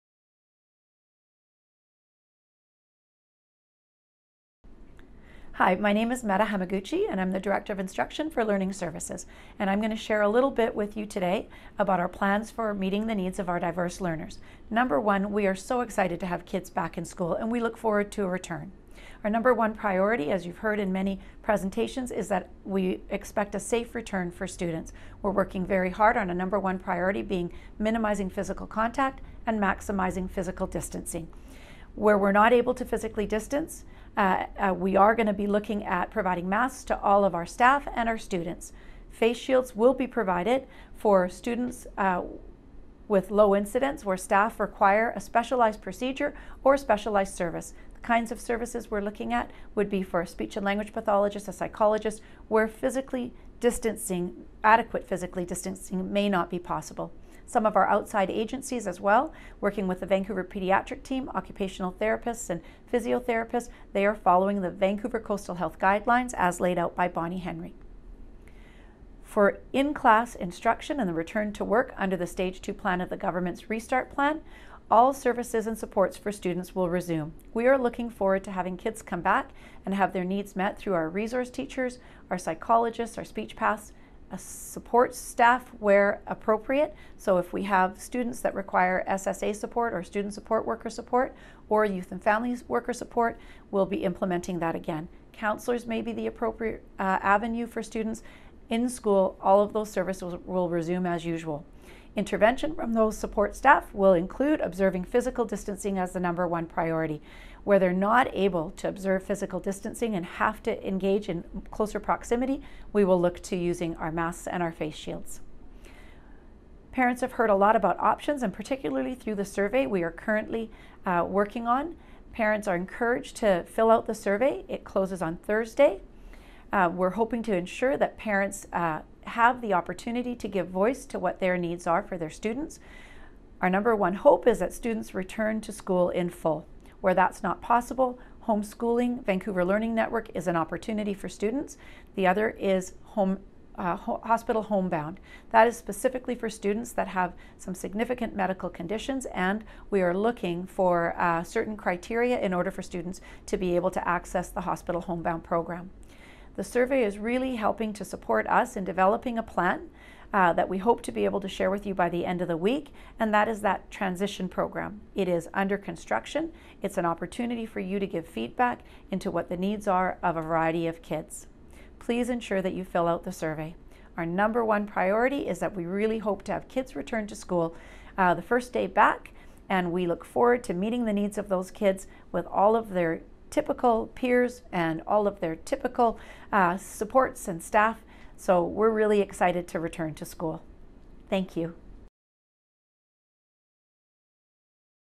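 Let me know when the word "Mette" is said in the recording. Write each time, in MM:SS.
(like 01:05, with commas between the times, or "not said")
00:06.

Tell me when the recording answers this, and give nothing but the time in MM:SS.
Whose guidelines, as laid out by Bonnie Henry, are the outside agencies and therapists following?
01:04.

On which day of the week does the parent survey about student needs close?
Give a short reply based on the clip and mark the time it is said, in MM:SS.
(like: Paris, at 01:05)
Thursday, at 02:05.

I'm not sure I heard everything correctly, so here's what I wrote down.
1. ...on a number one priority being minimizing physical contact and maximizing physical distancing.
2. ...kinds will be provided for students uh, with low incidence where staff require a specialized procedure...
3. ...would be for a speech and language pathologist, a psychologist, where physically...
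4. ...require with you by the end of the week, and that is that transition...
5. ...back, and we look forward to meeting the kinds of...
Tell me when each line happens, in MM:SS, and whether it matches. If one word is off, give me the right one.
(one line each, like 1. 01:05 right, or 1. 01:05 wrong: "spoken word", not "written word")
1. 00:26 right
2. 00:39 wrong: "shields", not "kinds"
3. 00:49 right
4. 02:41 wrong: "share", not "require"
5. 02:58 wrong: "needs", not "kinds".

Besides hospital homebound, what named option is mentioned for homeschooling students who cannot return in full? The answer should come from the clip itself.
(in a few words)
Vancouver Learning Network.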